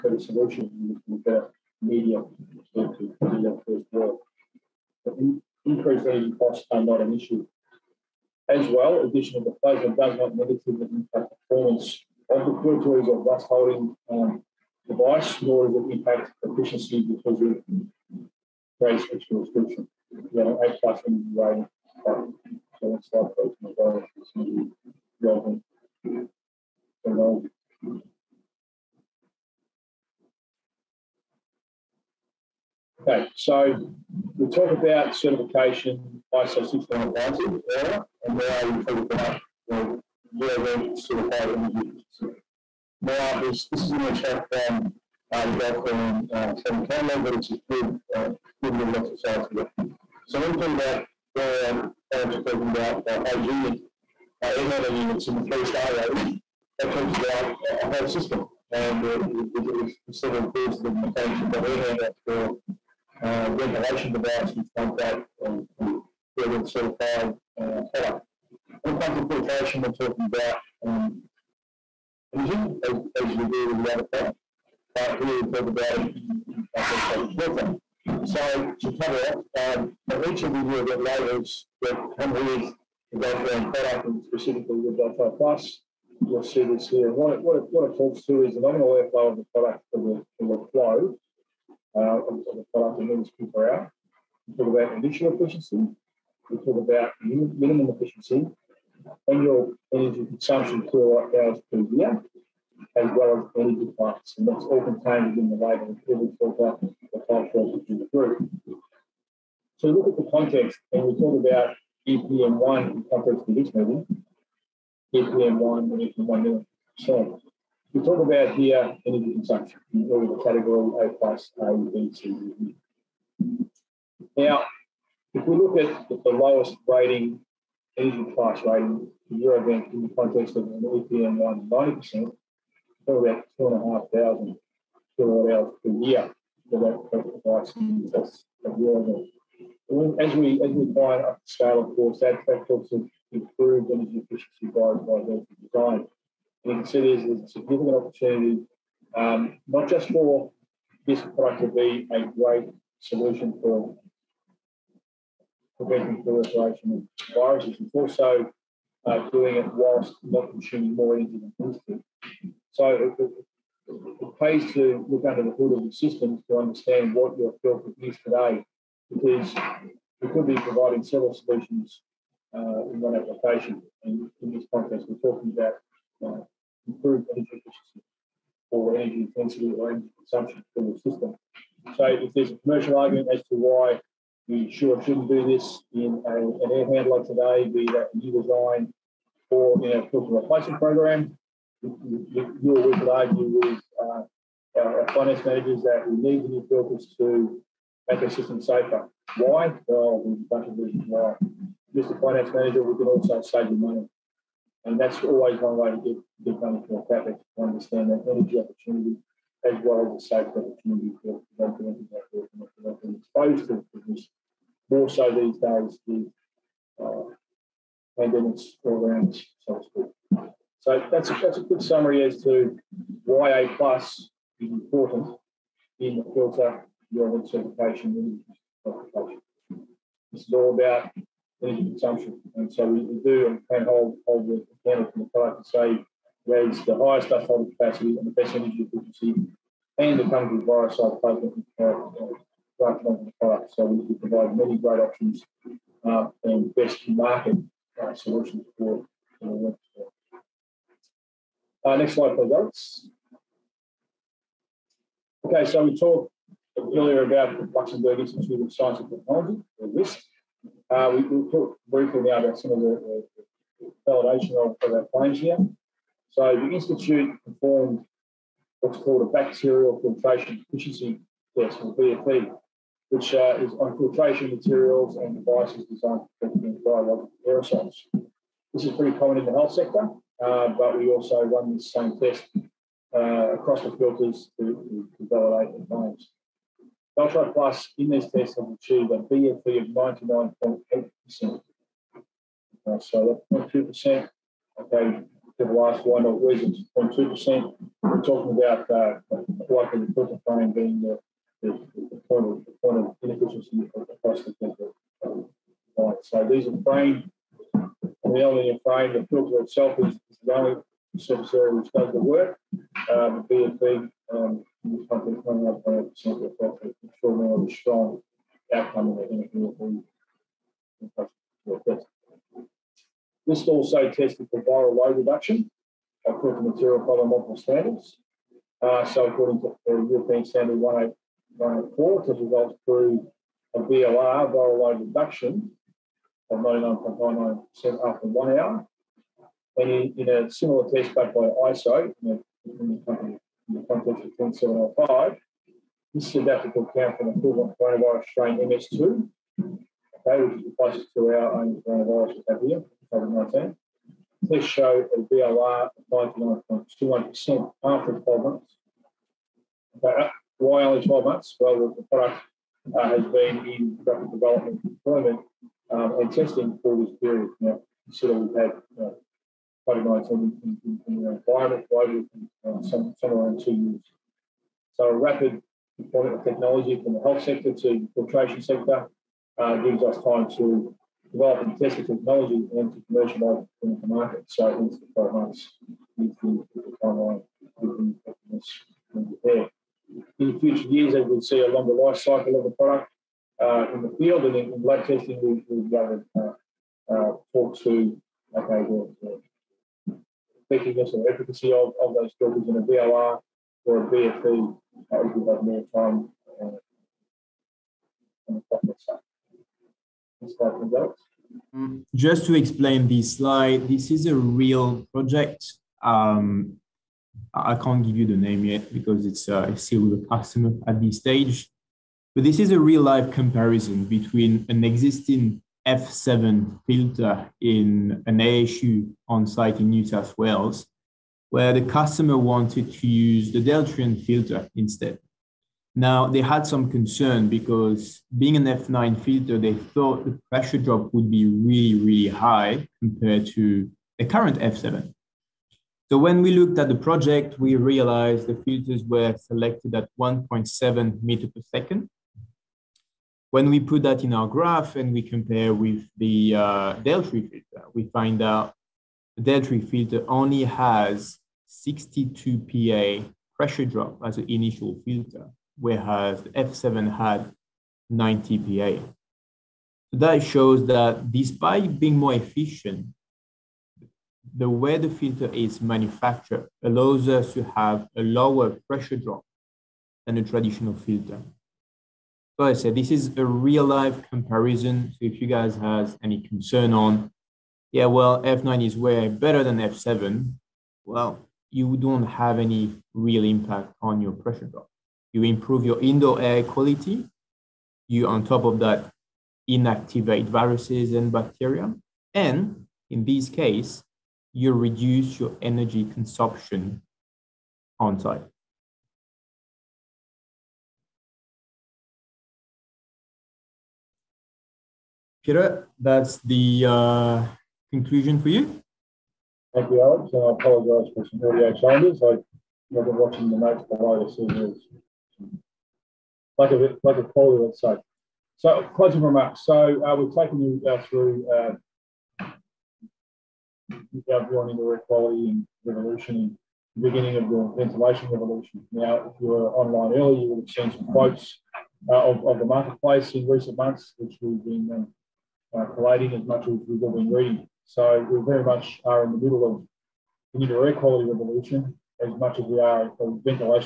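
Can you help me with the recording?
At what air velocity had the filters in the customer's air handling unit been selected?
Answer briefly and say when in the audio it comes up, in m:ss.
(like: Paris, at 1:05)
1.7 meters per second, at 7:30.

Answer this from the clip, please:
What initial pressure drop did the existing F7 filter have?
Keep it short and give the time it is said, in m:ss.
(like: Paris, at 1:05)
90 Pa, at 7:48.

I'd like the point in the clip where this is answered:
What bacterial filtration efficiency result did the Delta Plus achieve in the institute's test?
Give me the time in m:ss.
4:49.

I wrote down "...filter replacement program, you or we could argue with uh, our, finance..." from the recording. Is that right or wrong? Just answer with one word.
right.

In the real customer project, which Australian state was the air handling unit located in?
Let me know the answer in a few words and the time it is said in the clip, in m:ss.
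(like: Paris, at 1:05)
New South Wales, at 7:09.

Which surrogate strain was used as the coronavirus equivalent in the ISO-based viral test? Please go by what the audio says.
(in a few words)
MS2.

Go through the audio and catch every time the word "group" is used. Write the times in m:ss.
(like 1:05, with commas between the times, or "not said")
1:48.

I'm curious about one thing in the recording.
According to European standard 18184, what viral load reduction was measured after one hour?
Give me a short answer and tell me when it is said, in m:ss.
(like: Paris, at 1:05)
99.99%, at 5:36.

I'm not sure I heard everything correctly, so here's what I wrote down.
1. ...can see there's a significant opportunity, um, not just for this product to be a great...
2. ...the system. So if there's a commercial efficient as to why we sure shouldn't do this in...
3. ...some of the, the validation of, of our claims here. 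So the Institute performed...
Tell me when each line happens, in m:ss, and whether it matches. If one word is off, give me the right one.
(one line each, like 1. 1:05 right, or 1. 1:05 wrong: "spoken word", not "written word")
1. 2:26 right
2. 3:00 wrong: "argument", not "efficient"
3. 4:22 right.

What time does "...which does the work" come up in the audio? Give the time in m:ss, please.
5:11.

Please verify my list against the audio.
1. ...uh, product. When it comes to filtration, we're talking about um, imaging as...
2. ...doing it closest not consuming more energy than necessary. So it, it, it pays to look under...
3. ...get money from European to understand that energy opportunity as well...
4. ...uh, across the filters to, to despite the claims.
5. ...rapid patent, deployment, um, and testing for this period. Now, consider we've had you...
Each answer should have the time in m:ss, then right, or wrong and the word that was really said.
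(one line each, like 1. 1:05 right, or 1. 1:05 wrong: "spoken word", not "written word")
1. 1:07 right
2. 2:39 wrong: "whilst", not "closest"
3. 3:26 wrong: "CapEx", not "European"
4. 4:43 wrong: "validate", not "despite"
5. 6:04 wrong: "development", not "patent".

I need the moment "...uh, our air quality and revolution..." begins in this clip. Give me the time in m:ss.
8:51.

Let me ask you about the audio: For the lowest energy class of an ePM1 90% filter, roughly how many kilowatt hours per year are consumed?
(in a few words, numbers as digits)
2,500.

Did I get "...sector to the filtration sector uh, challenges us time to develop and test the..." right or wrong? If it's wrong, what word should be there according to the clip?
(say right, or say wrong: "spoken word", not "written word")
wrong: "gives", not "challenges".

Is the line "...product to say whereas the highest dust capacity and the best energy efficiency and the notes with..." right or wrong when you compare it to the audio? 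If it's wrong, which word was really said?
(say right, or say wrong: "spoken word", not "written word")
wrong: "comes", not "notes".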